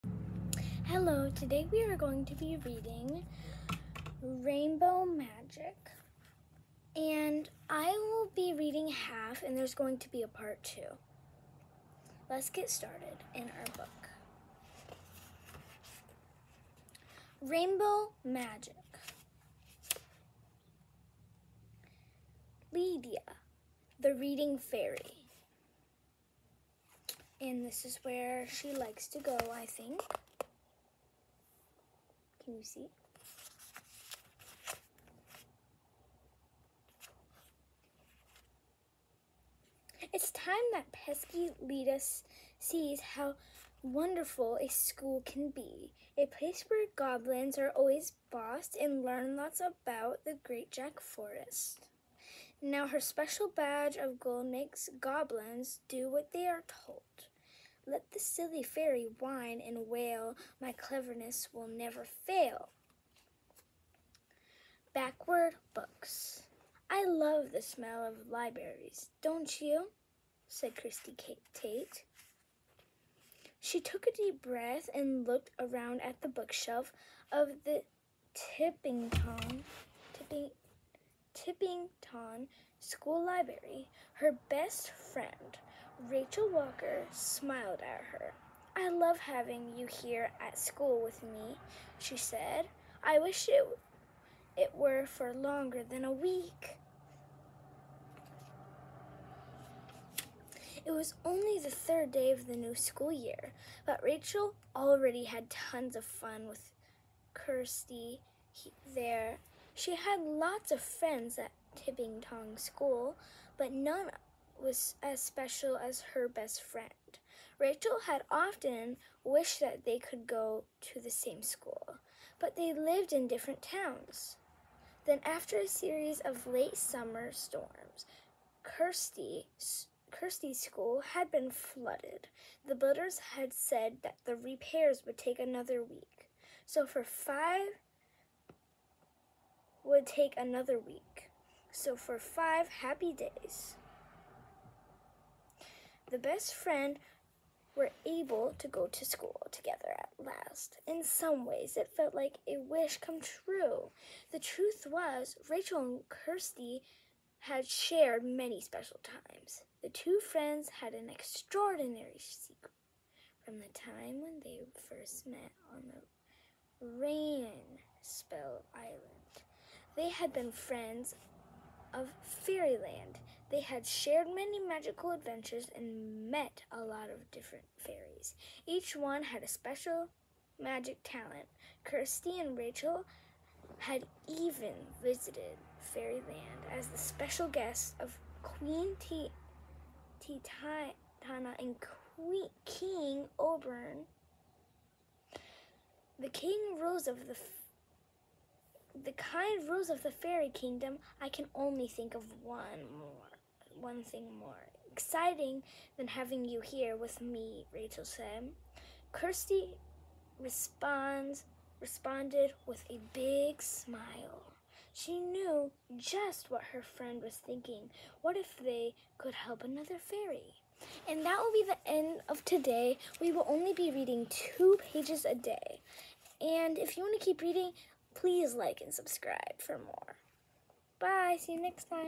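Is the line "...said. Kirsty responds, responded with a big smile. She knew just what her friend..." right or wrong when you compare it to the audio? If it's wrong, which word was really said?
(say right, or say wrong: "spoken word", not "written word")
right.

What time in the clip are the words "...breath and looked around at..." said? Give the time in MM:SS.
01:14.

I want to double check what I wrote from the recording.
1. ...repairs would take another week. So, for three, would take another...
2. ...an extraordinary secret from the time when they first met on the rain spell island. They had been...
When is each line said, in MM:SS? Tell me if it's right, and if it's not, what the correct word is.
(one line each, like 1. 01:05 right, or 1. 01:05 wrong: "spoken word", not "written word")
1. 02:14 wrong: "five", not "three"
2. 02:40 right.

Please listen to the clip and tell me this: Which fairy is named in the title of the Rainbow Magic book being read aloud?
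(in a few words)
Lydia, the Reading Fairy.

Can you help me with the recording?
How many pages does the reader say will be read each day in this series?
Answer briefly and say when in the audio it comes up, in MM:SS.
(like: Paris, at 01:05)
2, at 03:44.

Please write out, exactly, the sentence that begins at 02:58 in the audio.
Each one had a special magic talent.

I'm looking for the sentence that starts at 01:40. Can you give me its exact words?
It was only the third day of the new school year, but Rachel already had tons of fun with Kirsty there.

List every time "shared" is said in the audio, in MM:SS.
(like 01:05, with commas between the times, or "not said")
02:37, 02:53.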